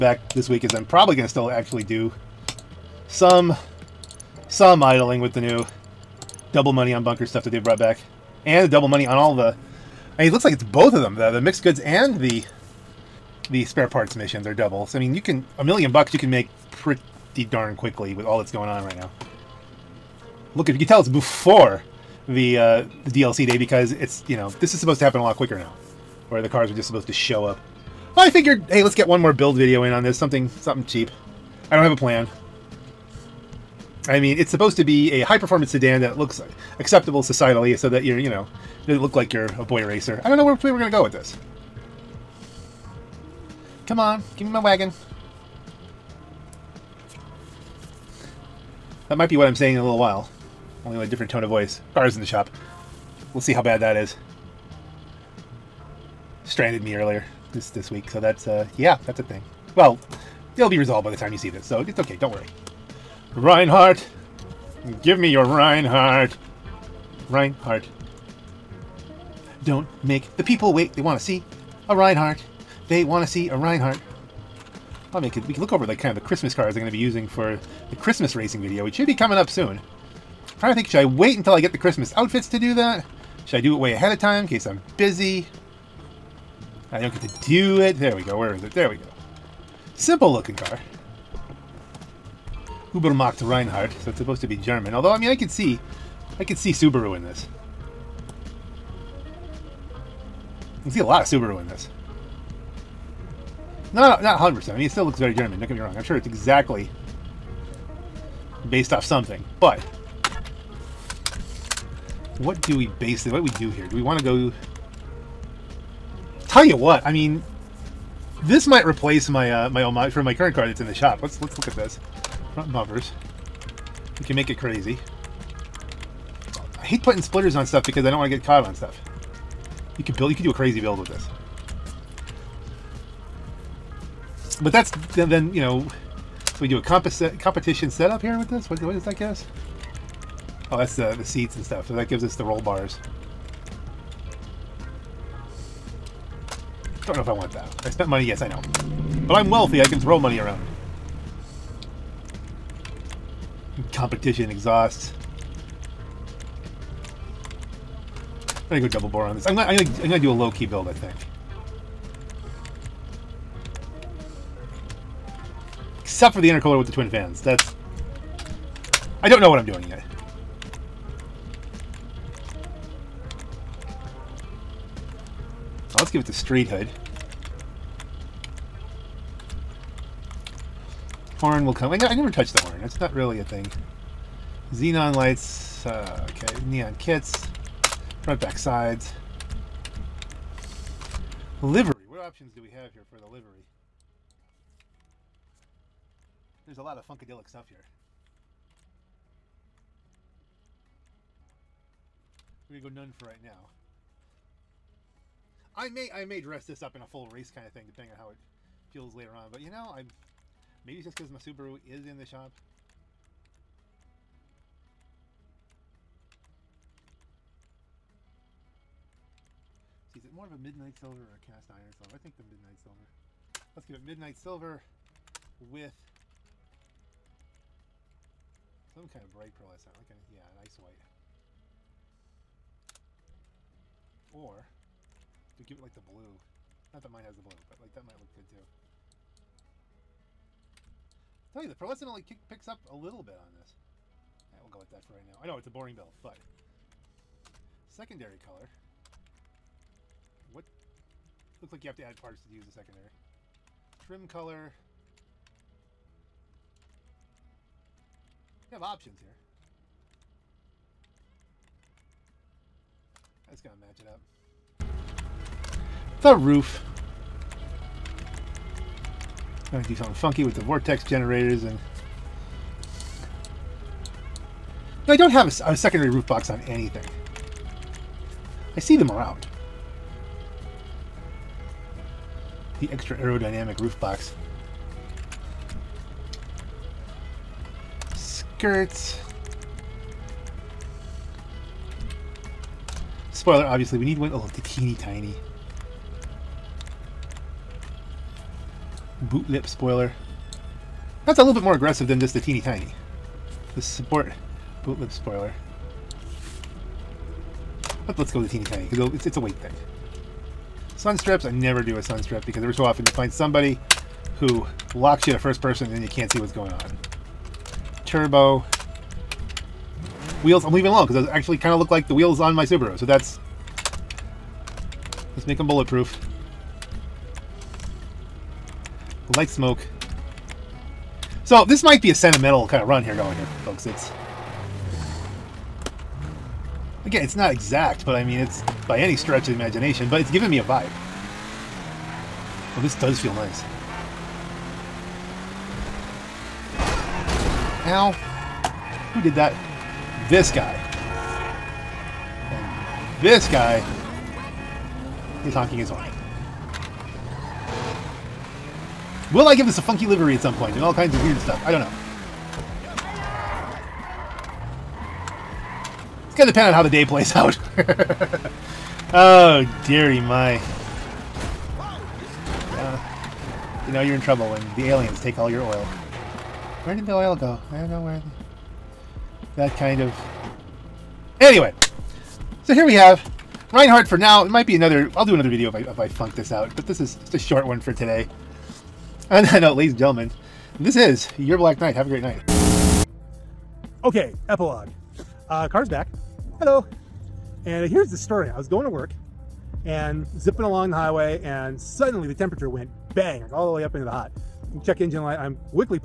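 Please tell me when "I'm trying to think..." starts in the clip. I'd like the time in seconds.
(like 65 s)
79 s.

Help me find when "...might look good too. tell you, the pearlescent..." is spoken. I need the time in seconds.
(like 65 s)
238 s.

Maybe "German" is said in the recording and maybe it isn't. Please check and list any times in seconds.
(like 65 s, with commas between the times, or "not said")
94 s, 105 s.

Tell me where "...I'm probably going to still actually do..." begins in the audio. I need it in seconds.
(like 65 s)
0 s.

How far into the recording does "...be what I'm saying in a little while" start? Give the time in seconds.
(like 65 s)
49 s.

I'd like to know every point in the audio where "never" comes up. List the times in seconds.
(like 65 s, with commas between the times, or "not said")
182 s, 311 s.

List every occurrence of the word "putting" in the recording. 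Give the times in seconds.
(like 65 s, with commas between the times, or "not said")
127 s.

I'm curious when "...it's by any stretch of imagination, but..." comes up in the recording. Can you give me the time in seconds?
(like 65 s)
338 s.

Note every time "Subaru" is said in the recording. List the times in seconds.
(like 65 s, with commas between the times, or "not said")
96 s, 101 s, 211 s, 322 s.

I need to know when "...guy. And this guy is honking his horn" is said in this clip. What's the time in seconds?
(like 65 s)
350 s.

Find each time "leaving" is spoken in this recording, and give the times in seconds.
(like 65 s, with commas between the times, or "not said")
320 s.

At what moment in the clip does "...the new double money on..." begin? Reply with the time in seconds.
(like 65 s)
5 s.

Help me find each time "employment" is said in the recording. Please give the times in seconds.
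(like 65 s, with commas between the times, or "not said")
not said.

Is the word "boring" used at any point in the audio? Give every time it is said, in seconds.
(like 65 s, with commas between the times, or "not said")
245 s.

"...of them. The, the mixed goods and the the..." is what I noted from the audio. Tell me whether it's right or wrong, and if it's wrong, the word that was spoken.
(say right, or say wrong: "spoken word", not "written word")
right.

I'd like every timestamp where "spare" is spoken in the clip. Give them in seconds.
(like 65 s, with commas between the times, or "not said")
13 s.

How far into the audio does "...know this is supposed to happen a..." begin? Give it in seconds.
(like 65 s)
24 s.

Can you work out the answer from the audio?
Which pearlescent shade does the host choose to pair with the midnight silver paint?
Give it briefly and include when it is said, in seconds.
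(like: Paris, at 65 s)
Ice white, at 230 s.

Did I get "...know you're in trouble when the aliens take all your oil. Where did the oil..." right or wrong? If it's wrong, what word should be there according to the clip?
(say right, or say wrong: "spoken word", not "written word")
right.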